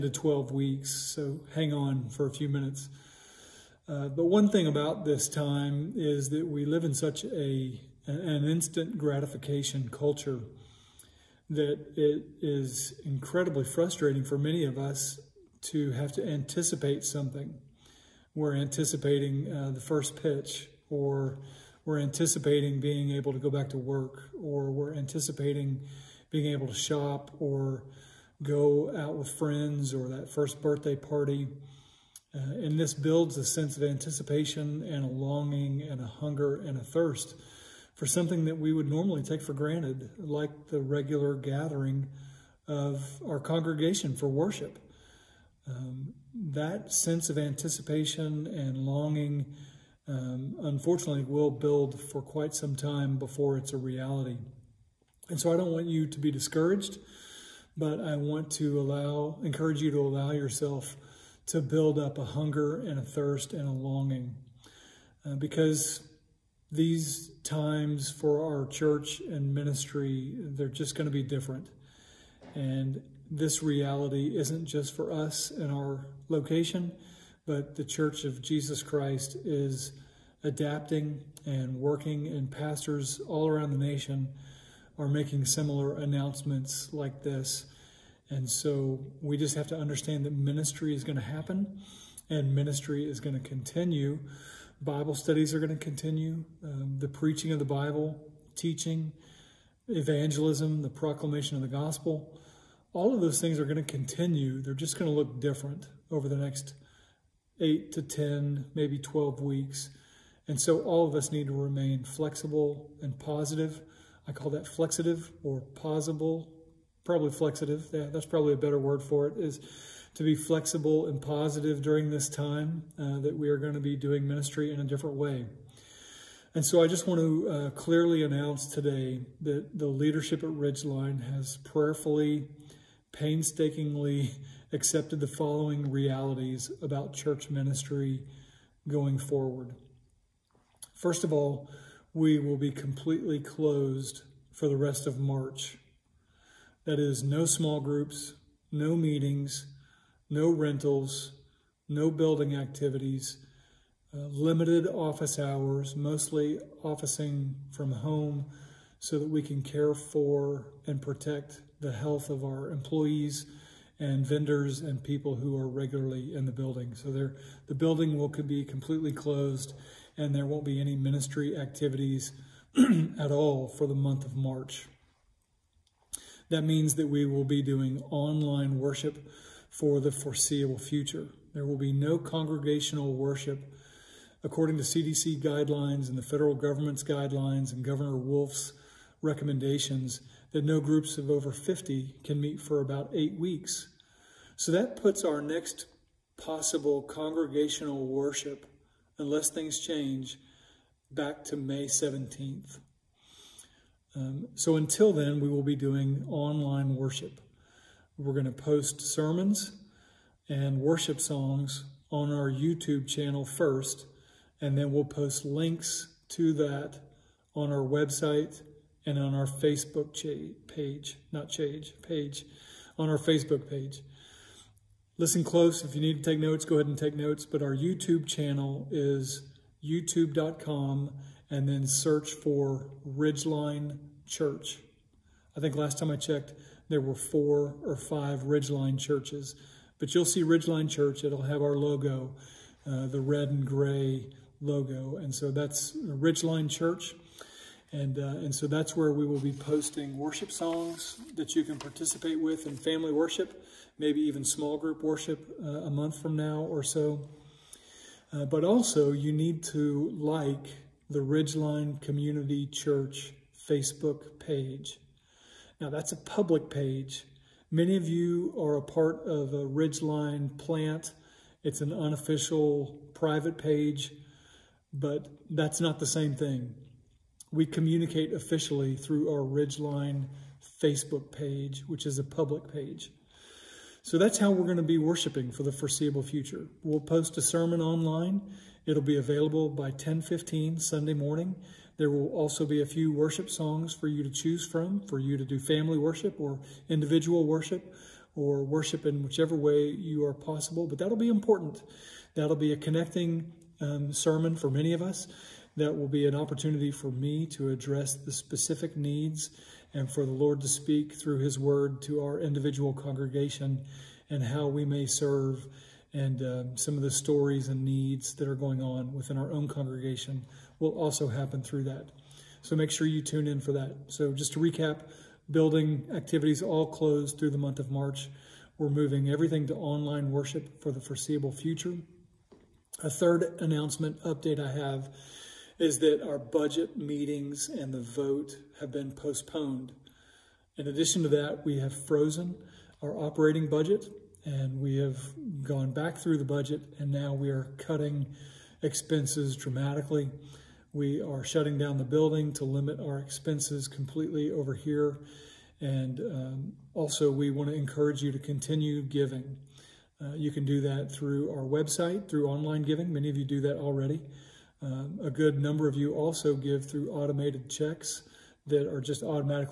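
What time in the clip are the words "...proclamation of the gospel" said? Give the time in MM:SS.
01:40.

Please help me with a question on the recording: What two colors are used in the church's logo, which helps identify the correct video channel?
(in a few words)
red and gray.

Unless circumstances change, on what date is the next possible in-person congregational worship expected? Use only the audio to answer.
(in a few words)
May 17th.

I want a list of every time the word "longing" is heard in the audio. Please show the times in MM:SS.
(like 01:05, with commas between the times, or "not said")
00:35, 00:48, 01:03.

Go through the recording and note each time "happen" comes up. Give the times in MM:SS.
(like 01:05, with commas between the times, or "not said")
01:31, 05:21.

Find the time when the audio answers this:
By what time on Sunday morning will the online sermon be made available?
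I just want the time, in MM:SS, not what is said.
04:49.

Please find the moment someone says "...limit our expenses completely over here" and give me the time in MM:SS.
05:52.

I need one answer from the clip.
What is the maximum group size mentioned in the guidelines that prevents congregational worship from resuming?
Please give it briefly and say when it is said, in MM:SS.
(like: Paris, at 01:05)
50, at 03:11.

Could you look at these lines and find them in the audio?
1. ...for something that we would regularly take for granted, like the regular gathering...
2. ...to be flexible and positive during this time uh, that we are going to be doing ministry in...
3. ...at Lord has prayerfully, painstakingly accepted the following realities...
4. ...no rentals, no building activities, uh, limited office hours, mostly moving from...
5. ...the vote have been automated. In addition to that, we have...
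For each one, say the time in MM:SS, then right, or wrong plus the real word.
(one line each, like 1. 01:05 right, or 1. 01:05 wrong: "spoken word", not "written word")
1. 00:37 wrong: "normally", not "regularly"
2. 02:00 right
3. 02:10 wrong: "Ridgeline", not "Lord"
4. 02:30 wrong: "officing", not "moving"
5. 05:37 wrong: "postponed", not "automated".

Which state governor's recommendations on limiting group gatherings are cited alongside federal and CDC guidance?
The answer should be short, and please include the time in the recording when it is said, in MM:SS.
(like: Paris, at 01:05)
Governor Wolf, at 03:07.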